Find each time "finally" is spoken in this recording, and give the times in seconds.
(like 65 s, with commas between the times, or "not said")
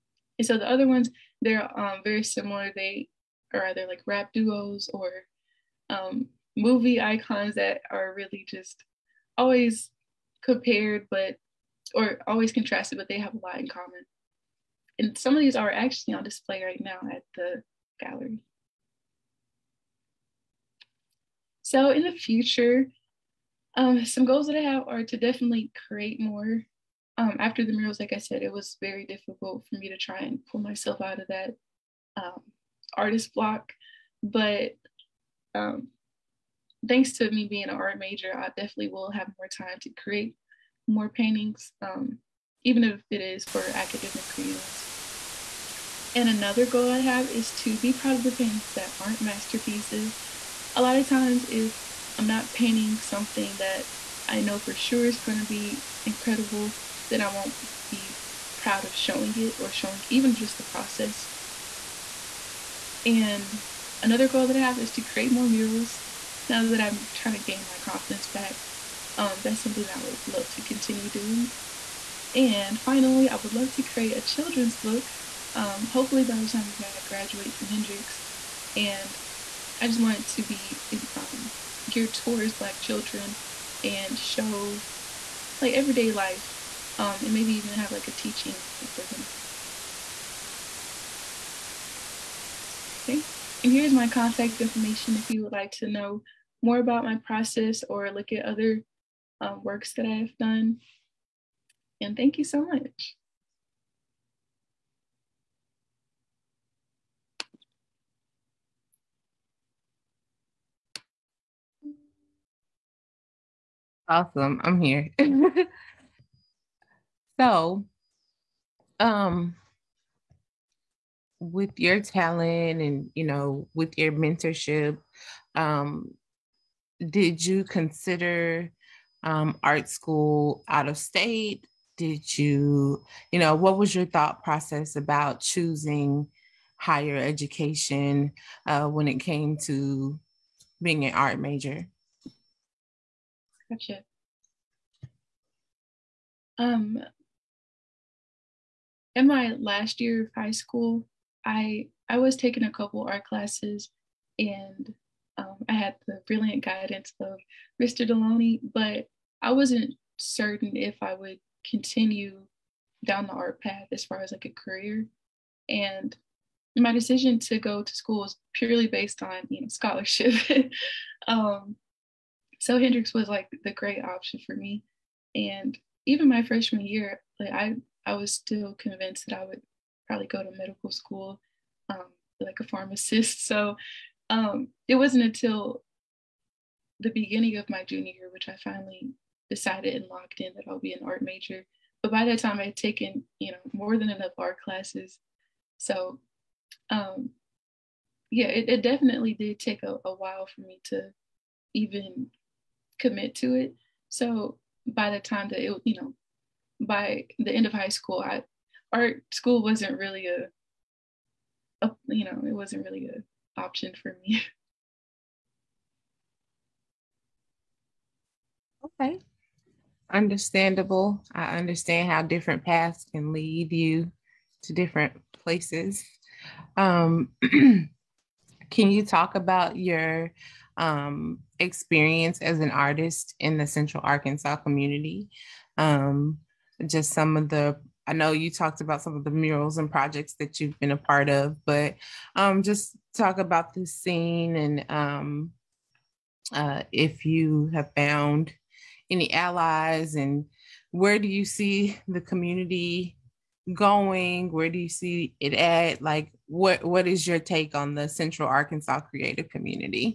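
72 s, 188 s.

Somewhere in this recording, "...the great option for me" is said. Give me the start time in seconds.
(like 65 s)
173 s.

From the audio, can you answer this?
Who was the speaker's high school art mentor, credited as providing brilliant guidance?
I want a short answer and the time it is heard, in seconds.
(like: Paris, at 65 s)
Mr. Deloney, at 157 s.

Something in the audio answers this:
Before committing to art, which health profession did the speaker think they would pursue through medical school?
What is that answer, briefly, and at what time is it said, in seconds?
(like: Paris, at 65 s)
Pharmacist, at 182 s.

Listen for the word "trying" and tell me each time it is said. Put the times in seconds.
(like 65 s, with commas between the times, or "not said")
67 s.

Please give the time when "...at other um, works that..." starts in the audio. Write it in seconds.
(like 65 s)
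98 s.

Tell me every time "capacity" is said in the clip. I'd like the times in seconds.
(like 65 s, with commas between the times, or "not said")
not said.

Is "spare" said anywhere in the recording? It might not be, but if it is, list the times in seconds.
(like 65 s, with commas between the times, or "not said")
not said.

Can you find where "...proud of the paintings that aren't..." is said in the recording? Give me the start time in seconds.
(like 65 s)
47 s.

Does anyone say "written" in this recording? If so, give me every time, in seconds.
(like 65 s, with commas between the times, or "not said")
not said.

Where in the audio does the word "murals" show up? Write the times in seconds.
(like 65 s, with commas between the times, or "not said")
27 s, 65 s, 239 s.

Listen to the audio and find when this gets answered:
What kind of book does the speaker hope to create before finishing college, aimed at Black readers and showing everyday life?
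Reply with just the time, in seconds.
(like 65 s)
74 s.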